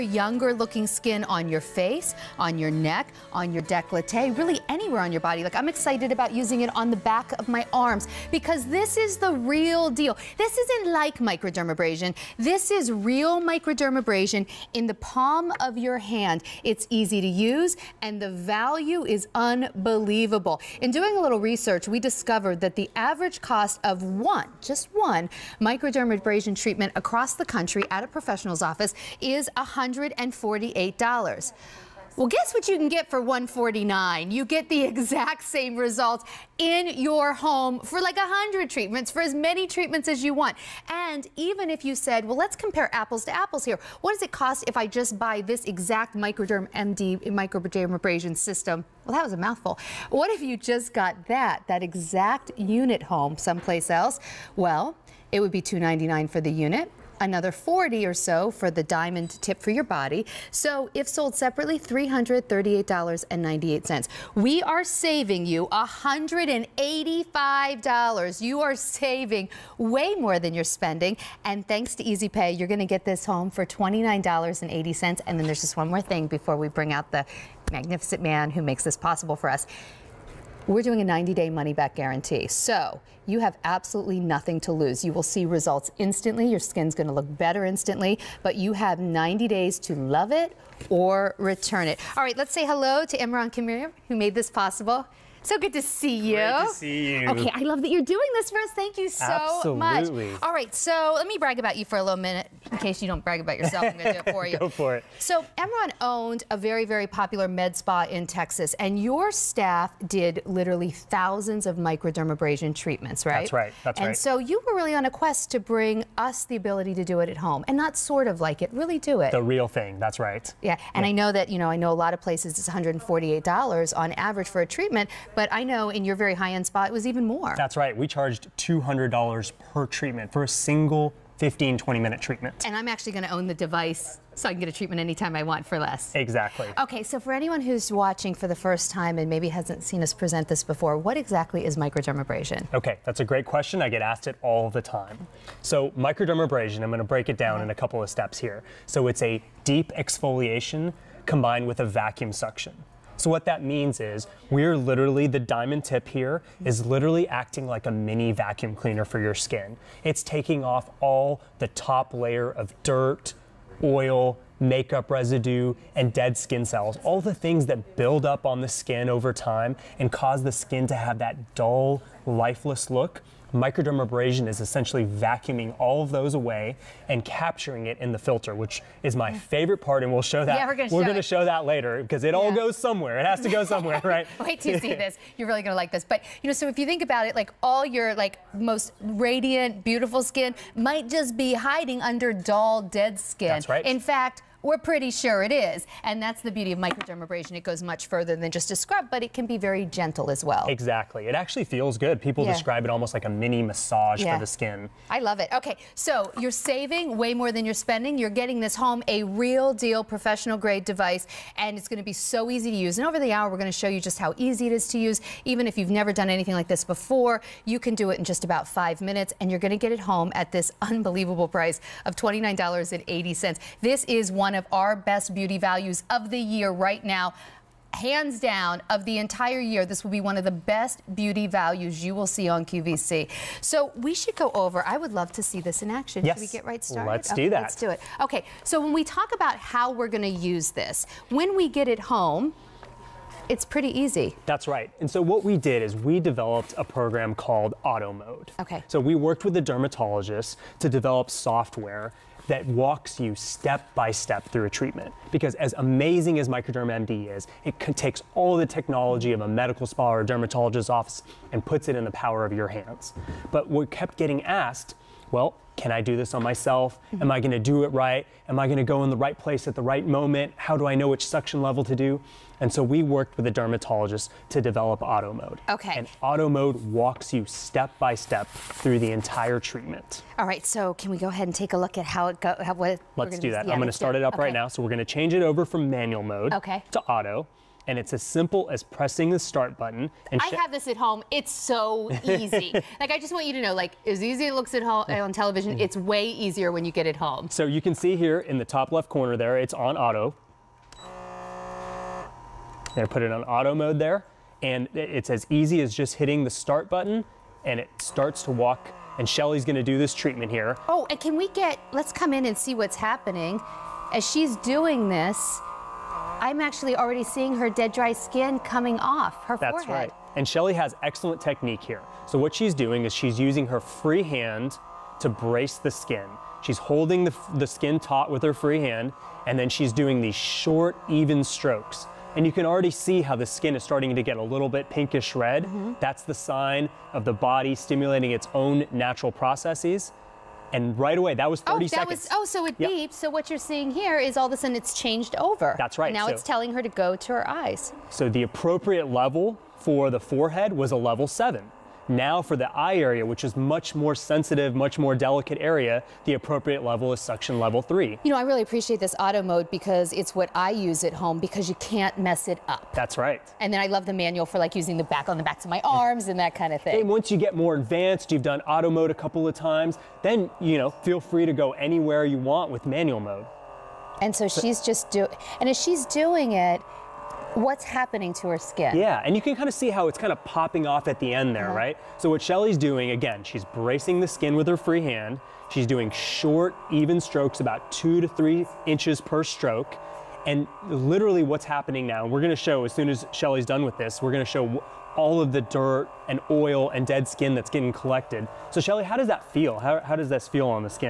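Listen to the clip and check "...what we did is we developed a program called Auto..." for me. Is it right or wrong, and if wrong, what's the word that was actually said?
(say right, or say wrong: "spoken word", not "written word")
right.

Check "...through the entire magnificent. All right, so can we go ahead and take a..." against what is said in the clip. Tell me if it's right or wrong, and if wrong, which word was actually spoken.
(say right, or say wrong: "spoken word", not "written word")
wrong: "treatment", not "magnificent".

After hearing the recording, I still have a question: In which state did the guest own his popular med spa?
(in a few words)
Texas.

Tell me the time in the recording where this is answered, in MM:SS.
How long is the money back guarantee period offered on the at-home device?
01:21.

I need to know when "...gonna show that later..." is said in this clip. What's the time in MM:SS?
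03:01.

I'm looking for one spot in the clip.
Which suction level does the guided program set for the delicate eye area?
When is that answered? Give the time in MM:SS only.
05:57.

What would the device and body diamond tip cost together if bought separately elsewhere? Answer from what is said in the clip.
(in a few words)
$338.98.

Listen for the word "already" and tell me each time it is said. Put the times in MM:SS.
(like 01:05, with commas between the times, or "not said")
05:16, 05:32.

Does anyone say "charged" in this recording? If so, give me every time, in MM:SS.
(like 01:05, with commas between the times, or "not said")
02:08.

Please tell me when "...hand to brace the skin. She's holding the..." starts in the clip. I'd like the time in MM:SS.
05:24.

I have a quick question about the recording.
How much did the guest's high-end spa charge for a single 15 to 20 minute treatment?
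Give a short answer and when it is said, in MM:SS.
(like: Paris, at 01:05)
$200, at 02:08.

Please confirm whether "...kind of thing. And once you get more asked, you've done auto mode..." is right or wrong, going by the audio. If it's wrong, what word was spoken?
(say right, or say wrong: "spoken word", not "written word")
wrong: "advanced", not "asked".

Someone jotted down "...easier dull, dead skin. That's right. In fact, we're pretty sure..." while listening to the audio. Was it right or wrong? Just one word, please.
wrong.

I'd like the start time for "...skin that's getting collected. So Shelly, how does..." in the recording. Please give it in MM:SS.
06:37.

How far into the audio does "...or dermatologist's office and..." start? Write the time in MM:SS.
04:20.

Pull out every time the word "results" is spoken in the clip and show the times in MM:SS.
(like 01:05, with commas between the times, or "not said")
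00:35, 01:25.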